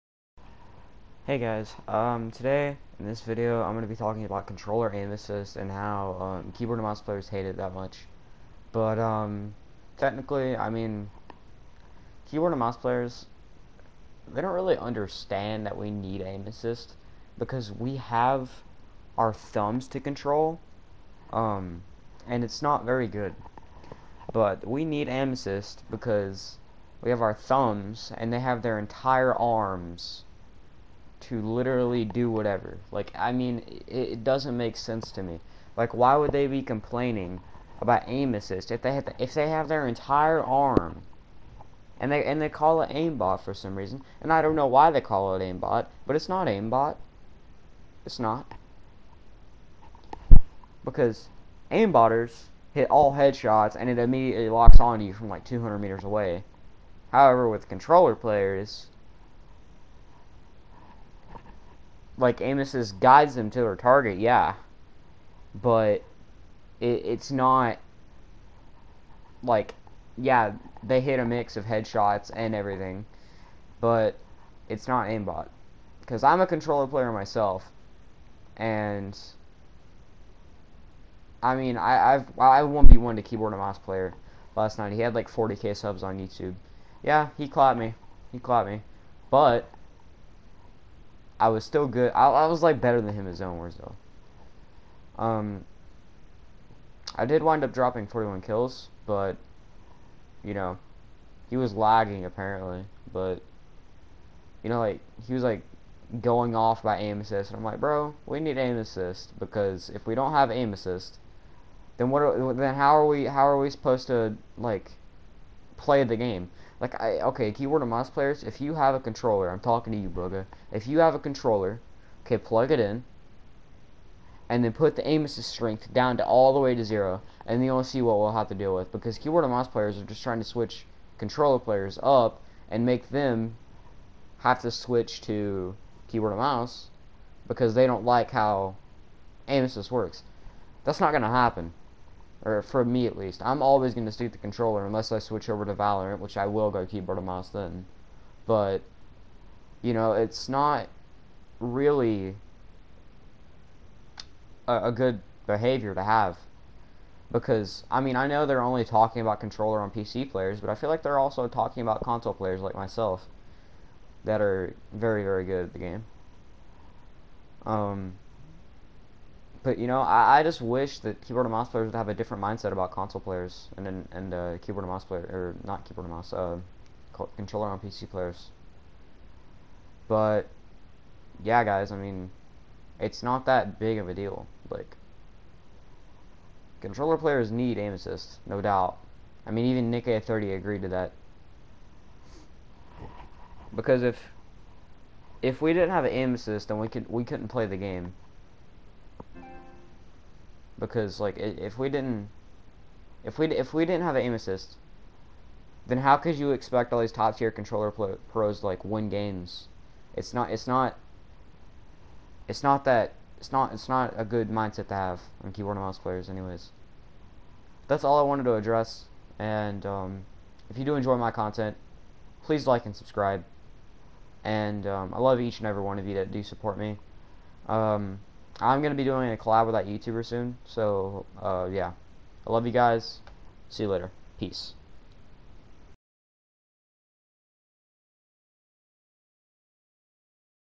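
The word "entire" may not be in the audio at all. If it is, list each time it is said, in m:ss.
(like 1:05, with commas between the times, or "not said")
0:28, 0:39.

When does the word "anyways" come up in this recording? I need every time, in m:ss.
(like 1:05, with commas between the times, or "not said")
3:36.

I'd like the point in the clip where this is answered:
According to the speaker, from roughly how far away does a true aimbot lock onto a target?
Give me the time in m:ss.
0:55.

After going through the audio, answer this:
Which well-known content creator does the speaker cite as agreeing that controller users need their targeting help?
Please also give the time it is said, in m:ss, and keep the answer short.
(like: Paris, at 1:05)
NickEh30, at 3:09.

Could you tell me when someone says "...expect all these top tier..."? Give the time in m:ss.
3:26.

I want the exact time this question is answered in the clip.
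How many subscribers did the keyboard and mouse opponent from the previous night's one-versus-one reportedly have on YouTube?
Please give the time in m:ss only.
1:25.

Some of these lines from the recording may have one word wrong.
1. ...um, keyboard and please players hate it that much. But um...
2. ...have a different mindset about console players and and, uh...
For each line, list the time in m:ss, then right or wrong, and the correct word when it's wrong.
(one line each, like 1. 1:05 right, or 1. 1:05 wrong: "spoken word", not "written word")
1. 0:06 wrong: "mouse", not "please"
2. 2:51 right.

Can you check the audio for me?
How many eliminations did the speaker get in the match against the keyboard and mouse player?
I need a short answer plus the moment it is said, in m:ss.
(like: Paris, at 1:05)
41, at 1:38.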